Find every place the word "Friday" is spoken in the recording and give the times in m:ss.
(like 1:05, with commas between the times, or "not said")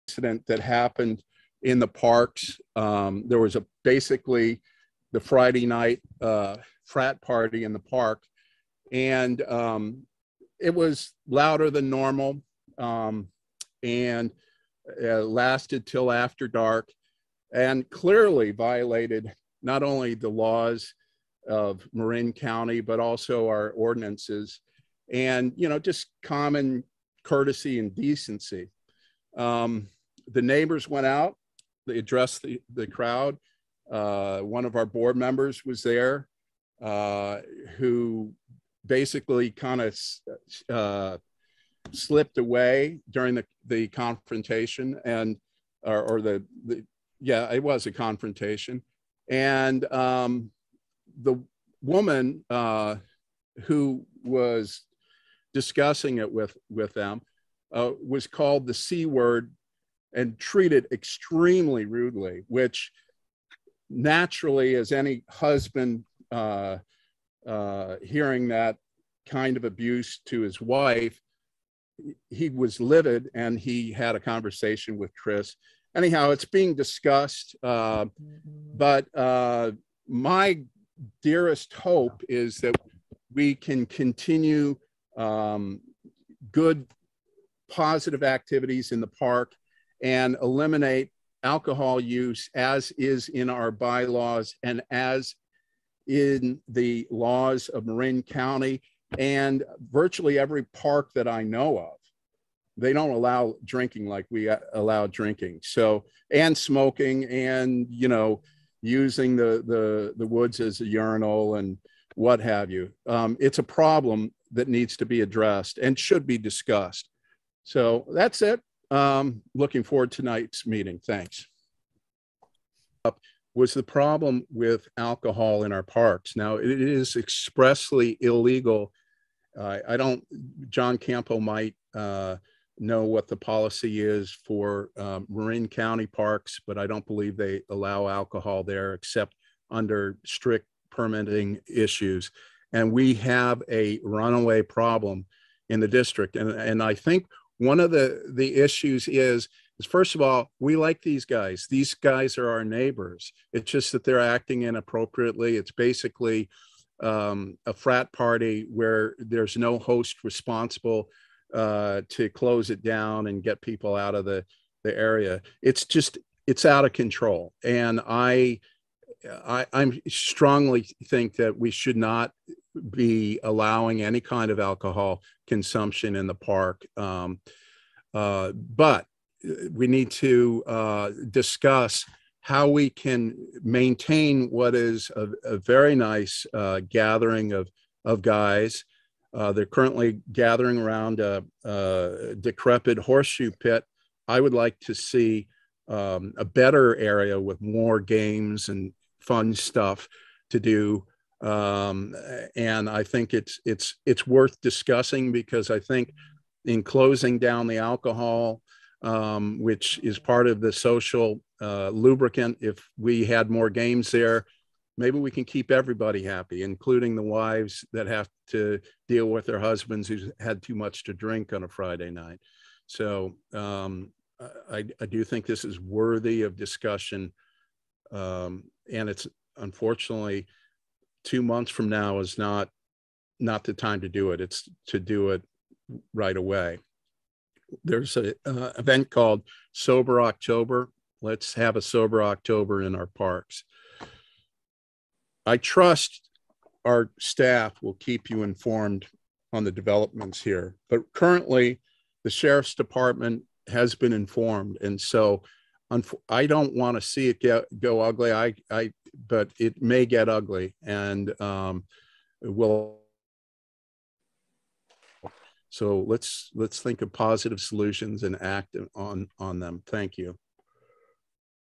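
0:05, 3:41.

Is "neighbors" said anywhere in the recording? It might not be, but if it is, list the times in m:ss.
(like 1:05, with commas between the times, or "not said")
0:30, 2:32.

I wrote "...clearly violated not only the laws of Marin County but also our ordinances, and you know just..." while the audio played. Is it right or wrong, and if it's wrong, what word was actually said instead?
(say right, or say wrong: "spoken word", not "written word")
right.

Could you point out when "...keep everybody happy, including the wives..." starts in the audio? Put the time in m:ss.
3:35.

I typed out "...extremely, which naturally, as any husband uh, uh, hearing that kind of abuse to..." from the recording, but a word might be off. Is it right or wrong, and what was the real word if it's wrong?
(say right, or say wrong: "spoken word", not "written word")
wrong: "rudely", not "extremely".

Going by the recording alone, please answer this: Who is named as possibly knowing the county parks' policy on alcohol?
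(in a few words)
John Campo.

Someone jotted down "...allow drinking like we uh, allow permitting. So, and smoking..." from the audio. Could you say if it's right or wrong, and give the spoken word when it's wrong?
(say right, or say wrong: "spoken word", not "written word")
wrong: "drinking", not "permitting".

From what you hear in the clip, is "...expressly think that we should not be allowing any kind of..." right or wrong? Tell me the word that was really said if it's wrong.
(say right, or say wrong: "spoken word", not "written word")
wrong: "strongly", not "expressly".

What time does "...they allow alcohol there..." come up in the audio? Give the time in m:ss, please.
2:17.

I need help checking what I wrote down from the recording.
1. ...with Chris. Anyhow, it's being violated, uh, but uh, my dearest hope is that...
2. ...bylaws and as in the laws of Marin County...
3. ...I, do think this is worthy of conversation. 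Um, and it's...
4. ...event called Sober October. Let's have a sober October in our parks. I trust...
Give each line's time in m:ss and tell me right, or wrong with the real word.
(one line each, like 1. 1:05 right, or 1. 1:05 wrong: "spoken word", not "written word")
1. 1:14 wrong: "discussed", not "violated"
2. 1:33 right
3. 3:44 wrong: "discussion", not "conversation"
4. 3:58 right.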